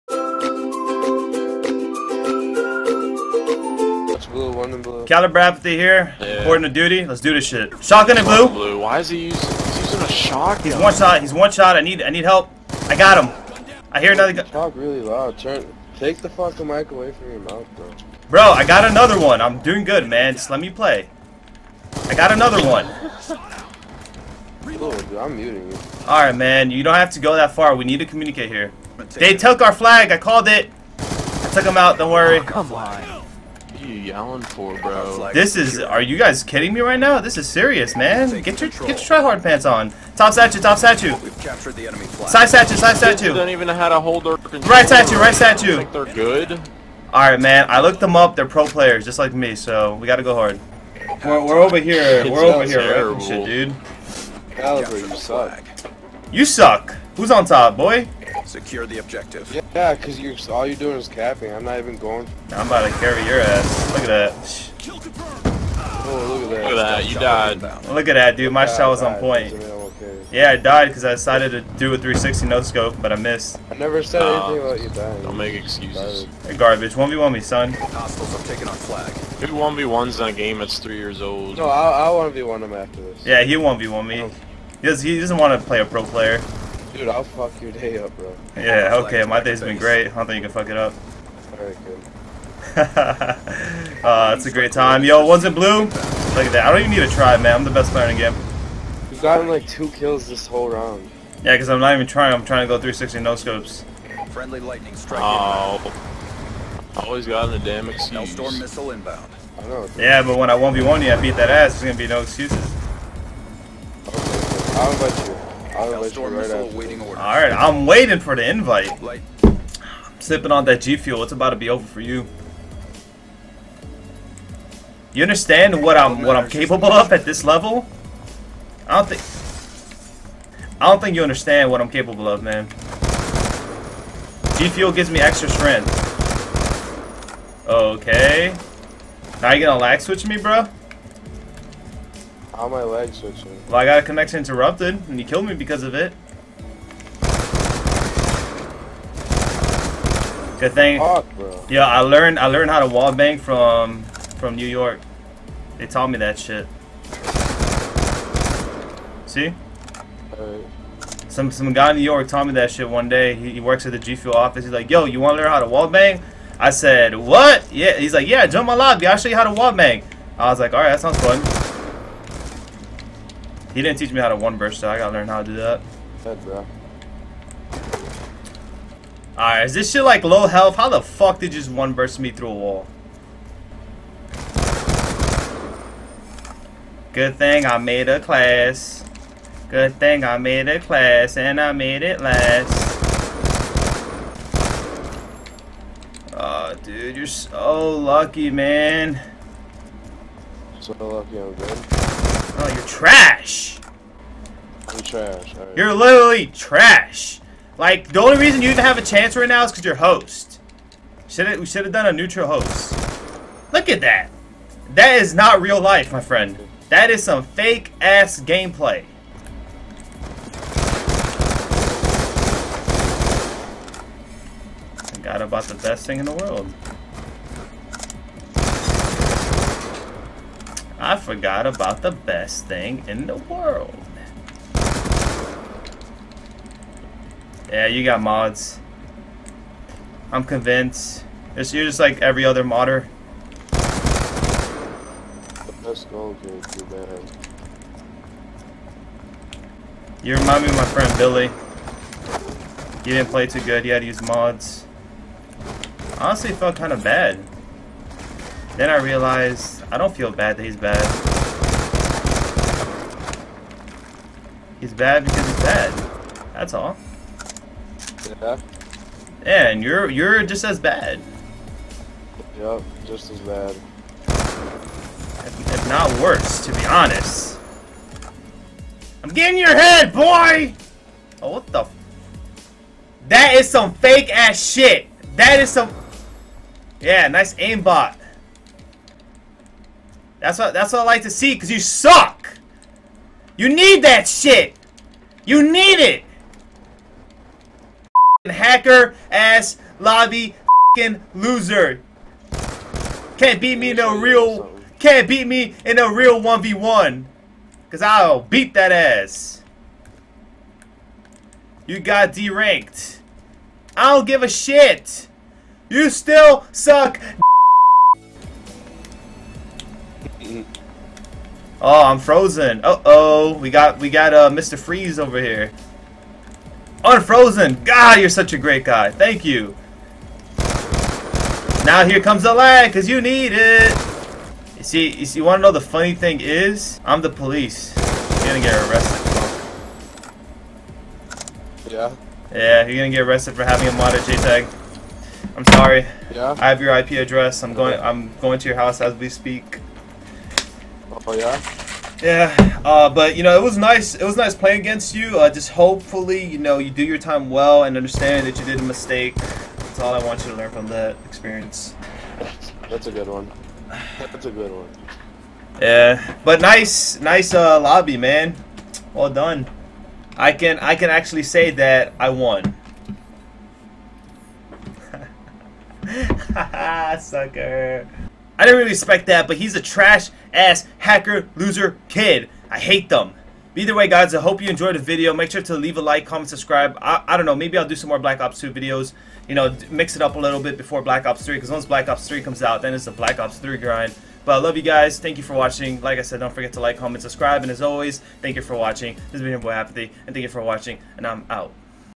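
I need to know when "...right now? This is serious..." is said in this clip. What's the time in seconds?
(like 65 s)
36 s.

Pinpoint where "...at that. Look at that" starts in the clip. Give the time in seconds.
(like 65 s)
66 s.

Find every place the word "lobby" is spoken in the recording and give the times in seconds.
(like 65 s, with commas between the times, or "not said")
168 s, 299 s, 367 s.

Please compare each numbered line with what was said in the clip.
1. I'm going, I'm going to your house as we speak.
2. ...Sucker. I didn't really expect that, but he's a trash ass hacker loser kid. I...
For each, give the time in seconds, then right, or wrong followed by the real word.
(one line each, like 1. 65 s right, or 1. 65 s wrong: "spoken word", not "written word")
1. 347 s right
2. 377 s right.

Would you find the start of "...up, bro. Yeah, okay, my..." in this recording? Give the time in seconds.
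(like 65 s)
87 s.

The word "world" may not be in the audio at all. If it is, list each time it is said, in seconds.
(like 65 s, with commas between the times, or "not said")
226 s, 233 s.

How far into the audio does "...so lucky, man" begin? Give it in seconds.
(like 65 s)
197 s.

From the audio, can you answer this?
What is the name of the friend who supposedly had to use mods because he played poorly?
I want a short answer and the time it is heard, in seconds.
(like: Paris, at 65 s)
Billy, at 251 s.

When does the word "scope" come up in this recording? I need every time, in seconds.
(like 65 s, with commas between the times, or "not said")
72 s, 103 s.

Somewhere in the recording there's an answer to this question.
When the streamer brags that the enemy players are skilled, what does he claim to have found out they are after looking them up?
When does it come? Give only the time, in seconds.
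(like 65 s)
48 s.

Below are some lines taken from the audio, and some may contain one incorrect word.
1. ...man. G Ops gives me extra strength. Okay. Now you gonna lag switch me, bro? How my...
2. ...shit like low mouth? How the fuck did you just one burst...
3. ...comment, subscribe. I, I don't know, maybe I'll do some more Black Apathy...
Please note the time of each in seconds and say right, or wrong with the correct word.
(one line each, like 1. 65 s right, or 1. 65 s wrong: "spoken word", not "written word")
1. 132 s wrong: "Fuel", not "Ops"
2. 179 s wrong: "health", not "mouth"
3. 386 s wrong: "Ops", not "Apathy".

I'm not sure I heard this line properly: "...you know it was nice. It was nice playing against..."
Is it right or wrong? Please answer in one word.
right.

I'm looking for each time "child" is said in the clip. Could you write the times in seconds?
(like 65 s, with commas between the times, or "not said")
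not said.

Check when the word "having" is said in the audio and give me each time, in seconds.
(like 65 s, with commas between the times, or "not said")
343 s.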